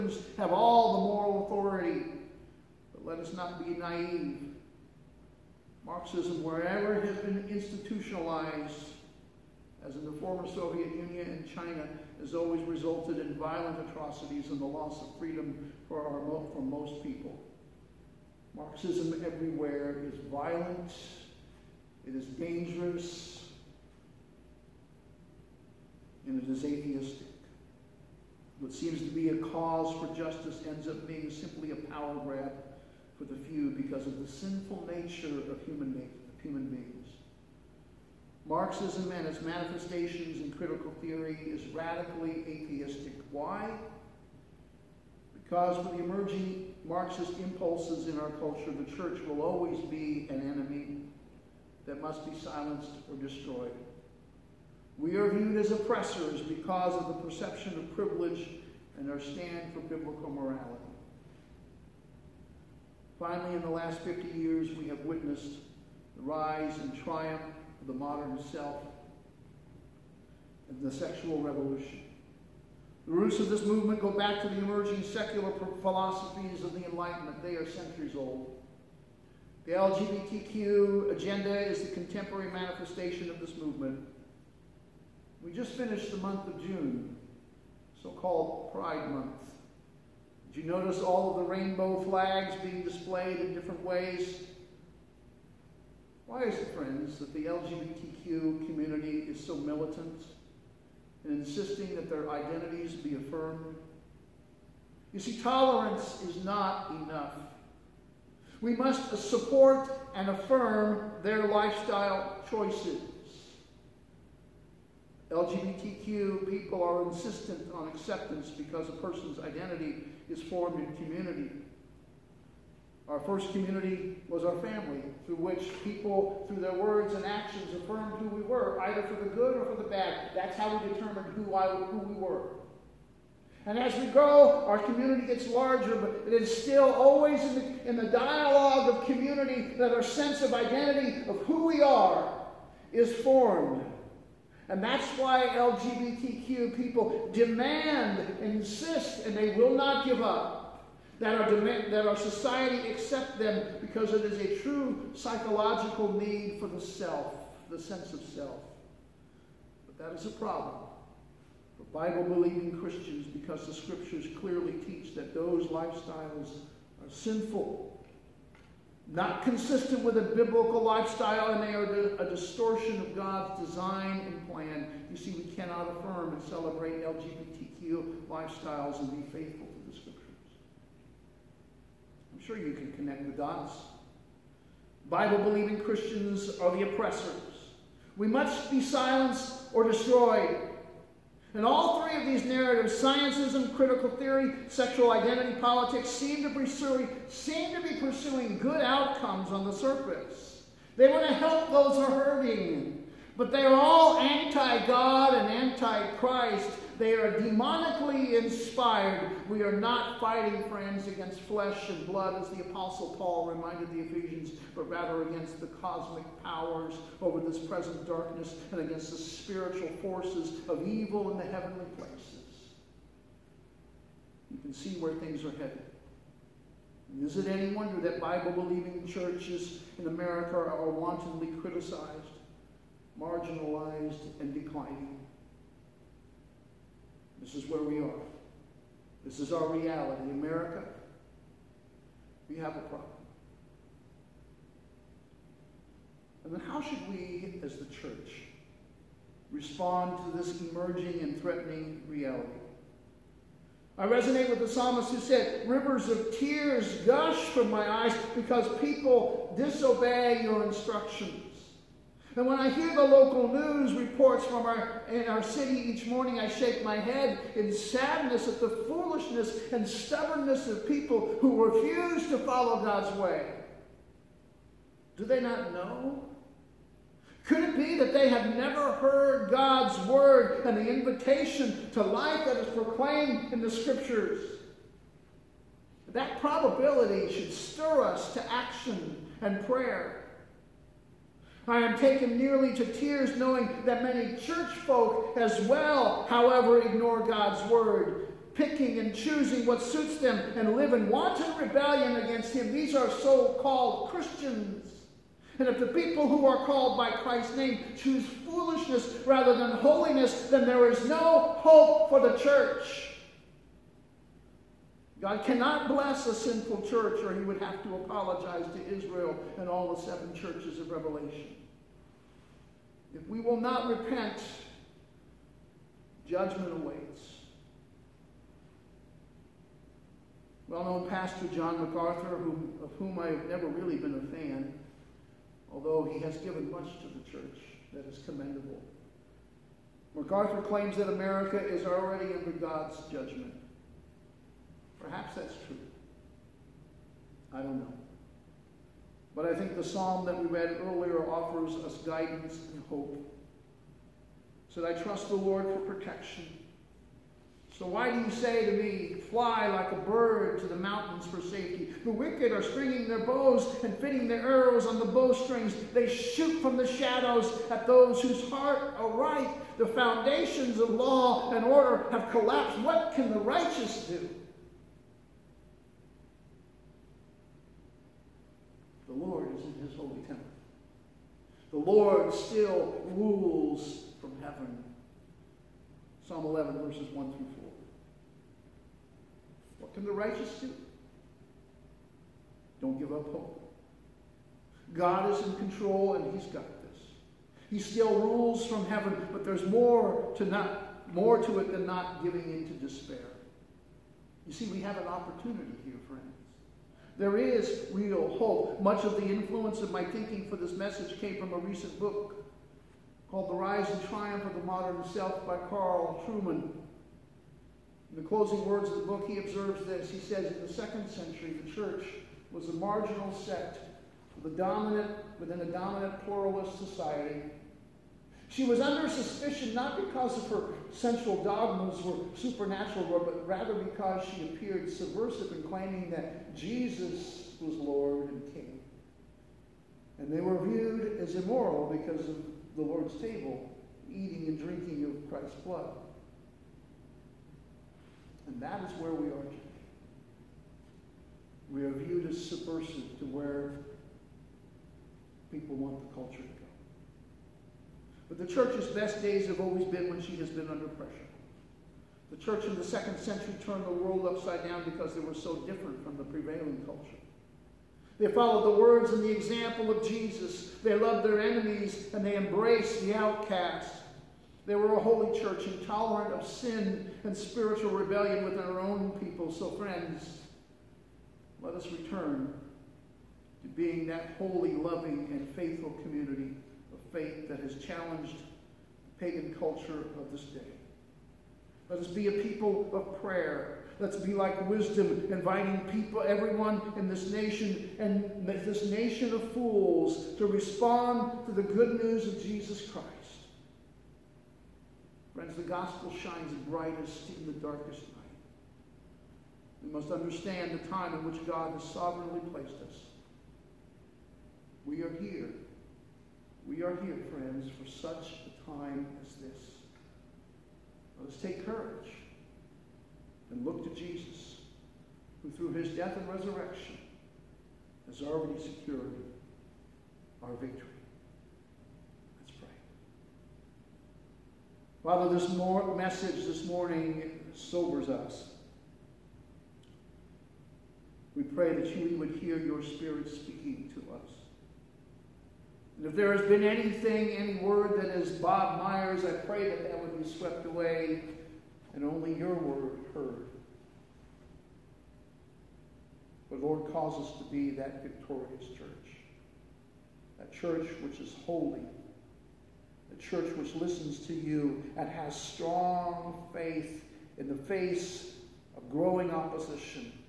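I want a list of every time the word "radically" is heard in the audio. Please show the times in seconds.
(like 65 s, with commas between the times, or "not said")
41 s.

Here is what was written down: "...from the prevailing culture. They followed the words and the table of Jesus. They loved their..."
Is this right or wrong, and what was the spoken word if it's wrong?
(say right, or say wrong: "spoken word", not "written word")
wrong: "example", not "table".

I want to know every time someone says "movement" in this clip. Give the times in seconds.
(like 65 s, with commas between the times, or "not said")
73 s, 83 s.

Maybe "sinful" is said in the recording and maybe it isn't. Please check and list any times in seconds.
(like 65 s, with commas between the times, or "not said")
34 s, 167 s, 316 s.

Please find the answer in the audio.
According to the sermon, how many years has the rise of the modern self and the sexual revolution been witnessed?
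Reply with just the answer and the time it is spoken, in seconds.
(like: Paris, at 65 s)
50, at 63 s.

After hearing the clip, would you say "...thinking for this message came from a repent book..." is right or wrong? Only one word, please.
wrong.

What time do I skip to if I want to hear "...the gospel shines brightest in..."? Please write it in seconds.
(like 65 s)
505 s.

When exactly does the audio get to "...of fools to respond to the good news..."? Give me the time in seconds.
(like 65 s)
499 s.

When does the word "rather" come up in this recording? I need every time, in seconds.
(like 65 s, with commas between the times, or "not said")
214 s, 309 s, 433 s.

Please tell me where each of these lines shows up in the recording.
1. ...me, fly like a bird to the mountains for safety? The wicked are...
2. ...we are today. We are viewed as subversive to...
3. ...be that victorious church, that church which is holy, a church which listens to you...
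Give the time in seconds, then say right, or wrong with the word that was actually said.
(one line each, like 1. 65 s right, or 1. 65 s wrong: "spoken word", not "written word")
1. 358 s right
2. 449 s right
3. 557 s right.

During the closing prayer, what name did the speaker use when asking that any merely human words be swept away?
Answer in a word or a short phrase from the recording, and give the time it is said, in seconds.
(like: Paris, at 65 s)
Bob Myers, at 548 s.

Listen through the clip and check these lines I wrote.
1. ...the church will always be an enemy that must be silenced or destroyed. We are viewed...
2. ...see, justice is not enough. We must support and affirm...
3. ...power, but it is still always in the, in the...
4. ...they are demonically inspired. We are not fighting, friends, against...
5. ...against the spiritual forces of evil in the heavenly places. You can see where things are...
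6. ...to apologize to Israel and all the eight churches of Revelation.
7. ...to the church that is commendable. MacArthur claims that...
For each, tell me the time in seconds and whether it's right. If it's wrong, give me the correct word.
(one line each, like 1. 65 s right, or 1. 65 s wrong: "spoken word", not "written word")
1. 48 s right
2. 105 s wrong: "tolerance", not "justice"
3. 135 s wrong: "larger", not "power"
4. 206 s right
5. 218 s right
6. 317 s wrong: "seven", not "eight"
7. 336 s right.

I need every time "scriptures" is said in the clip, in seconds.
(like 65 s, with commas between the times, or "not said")
163 s, 283 s.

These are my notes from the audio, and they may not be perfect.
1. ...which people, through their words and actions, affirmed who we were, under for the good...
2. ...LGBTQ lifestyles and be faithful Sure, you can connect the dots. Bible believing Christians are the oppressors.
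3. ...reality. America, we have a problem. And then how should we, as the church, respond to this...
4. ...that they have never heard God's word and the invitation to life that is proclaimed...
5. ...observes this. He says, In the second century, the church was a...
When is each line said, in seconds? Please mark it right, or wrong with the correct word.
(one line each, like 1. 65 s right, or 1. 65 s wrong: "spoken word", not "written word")
1. 125 s wrong: "either", not "under"
2. 177 s right
3. 239 s right
4. 277 s right
5. 419 s right.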